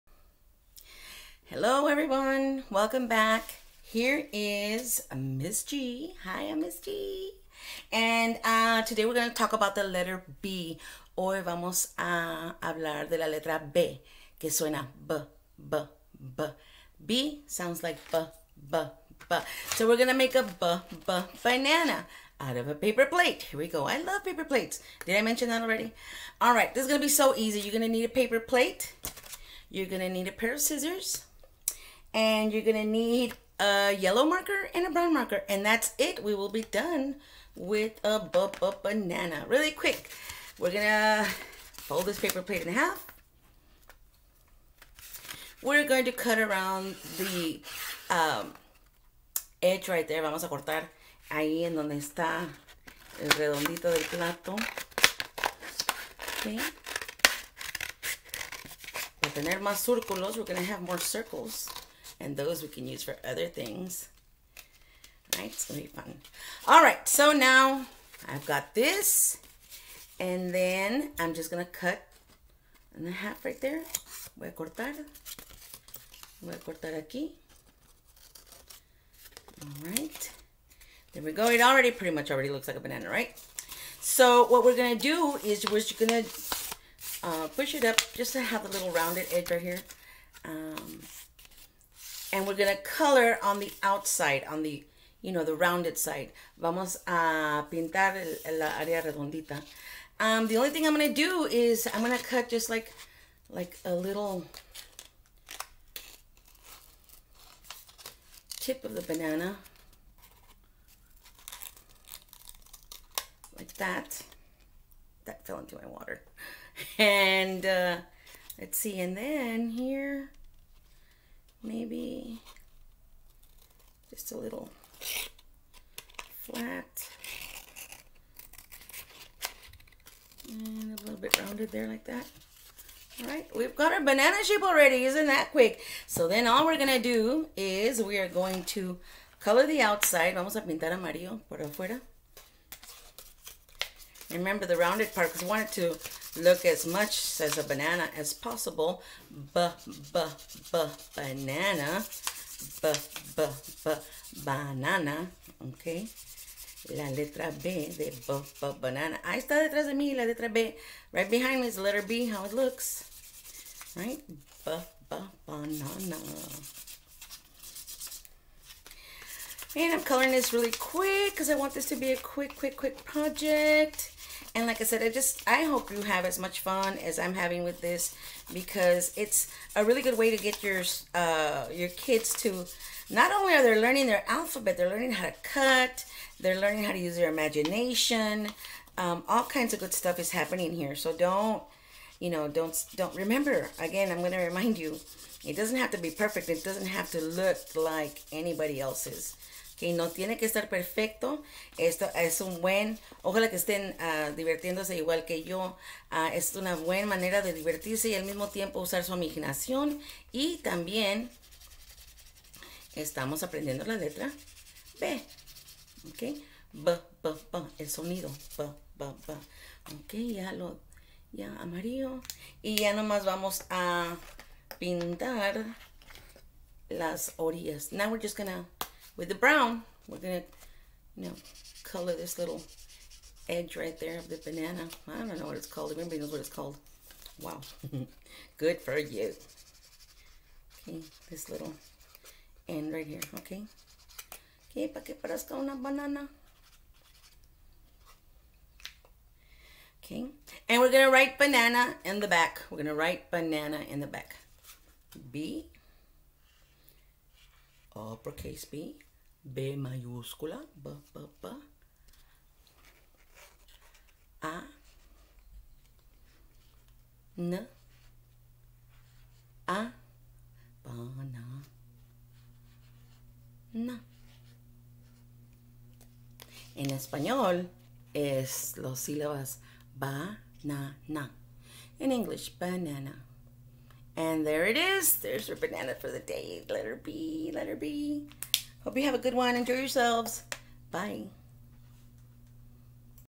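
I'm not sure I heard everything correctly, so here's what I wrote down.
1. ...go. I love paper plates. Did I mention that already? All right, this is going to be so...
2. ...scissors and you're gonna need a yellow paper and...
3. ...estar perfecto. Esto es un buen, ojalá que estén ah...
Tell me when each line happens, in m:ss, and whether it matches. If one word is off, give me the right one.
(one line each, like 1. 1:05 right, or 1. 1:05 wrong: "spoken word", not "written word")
1. 0:23 right
2. 0:30 wrong: "marker", not "paper"
3. 3:20 right.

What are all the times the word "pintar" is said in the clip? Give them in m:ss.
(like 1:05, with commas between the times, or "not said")
1:37, 2:20, 3:44.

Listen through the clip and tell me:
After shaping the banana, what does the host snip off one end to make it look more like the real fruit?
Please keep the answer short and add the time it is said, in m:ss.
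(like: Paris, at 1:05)
a little tip, at 1:43.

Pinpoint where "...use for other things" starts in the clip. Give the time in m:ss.
1:02.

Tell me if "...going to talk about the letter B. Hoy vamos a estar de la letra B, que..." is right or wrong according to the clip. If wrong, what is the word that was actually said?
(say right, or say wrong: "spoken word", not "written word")
wrong: "hablar", not "estar".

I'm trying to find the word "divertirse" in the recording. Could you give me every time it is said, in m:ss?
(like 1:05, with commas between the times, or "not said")
3:27.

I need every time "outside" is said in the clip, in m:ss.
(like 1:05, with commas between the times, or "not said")
1:33, 2:19.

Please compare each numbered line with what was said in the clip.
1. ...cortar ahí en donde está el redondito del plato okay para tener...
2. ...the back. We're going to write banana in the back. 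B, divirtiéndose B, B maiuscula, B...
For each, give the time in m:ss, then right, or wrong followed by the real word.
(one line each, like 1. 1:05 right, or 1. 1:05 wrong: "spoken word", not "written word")
1. 0:50 right
2. 4:12 wrong: "uppercase", not "divirtiéndose".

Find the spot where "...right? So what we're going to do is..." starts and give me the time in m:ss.
1:23.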